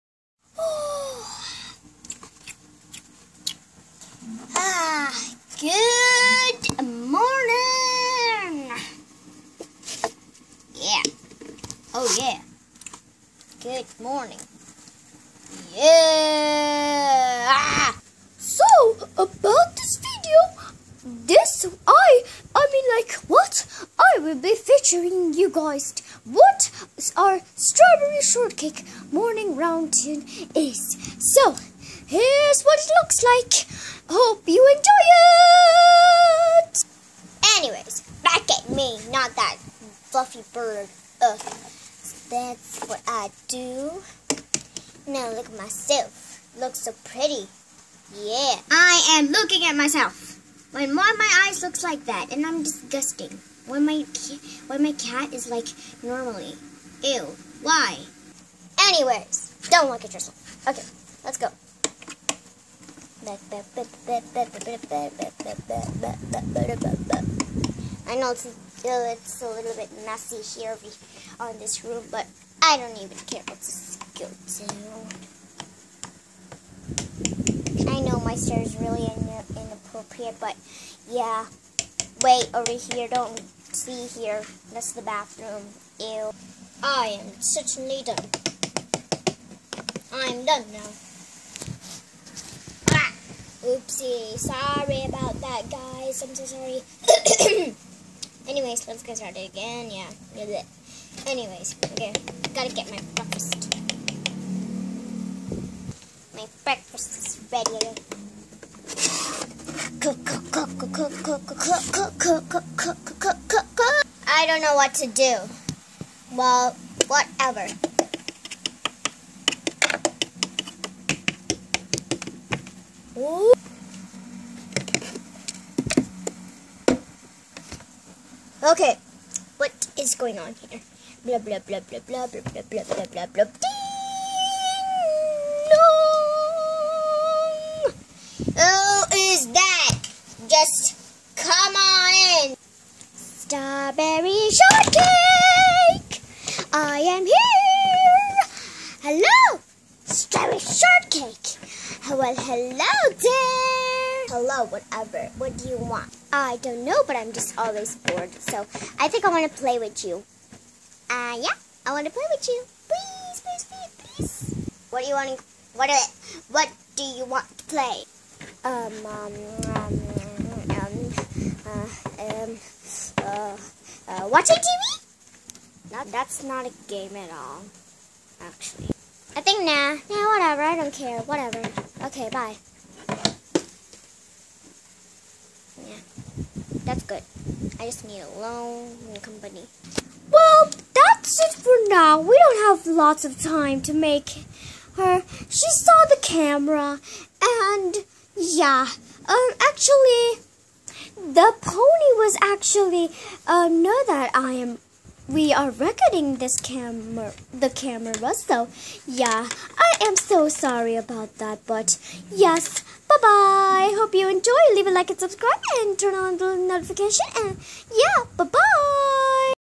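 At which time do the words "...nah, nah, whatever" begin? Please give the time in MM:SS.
02:59.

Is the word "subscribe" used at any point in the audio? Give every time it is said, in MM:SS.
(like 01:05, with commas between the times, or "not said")
03:35.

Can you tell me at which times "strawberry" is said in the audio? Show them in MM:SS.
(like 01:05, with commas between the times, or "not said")
00:27, 02:23, 02:30.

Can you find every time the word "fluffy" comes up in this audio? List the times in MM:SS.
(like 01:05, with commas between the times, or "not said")
00:40.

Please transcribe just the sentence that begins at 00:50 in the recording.
When one of my eyes looks like that, and I'm disgusting.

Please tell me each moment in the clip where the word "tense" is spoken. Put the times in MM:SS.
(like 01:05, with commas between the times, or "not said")
not said.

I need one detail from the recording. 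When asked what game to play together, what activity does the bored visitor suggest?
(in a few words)
watching TV.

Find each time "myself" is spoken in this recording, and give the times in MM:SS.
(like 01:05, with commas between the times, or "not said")
00:45, 00:49.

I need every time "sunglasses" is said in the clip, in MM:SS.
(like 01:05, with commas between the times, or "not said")
not said.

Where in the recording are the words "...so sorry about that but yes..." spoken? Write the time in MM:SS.
03:30.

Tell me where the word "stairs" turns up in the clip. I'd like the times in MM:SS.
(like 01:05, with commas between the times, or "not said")
01:18.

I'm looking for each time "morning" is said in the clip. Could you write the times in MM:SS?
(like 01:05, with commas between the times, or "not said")
00:14, 00:29.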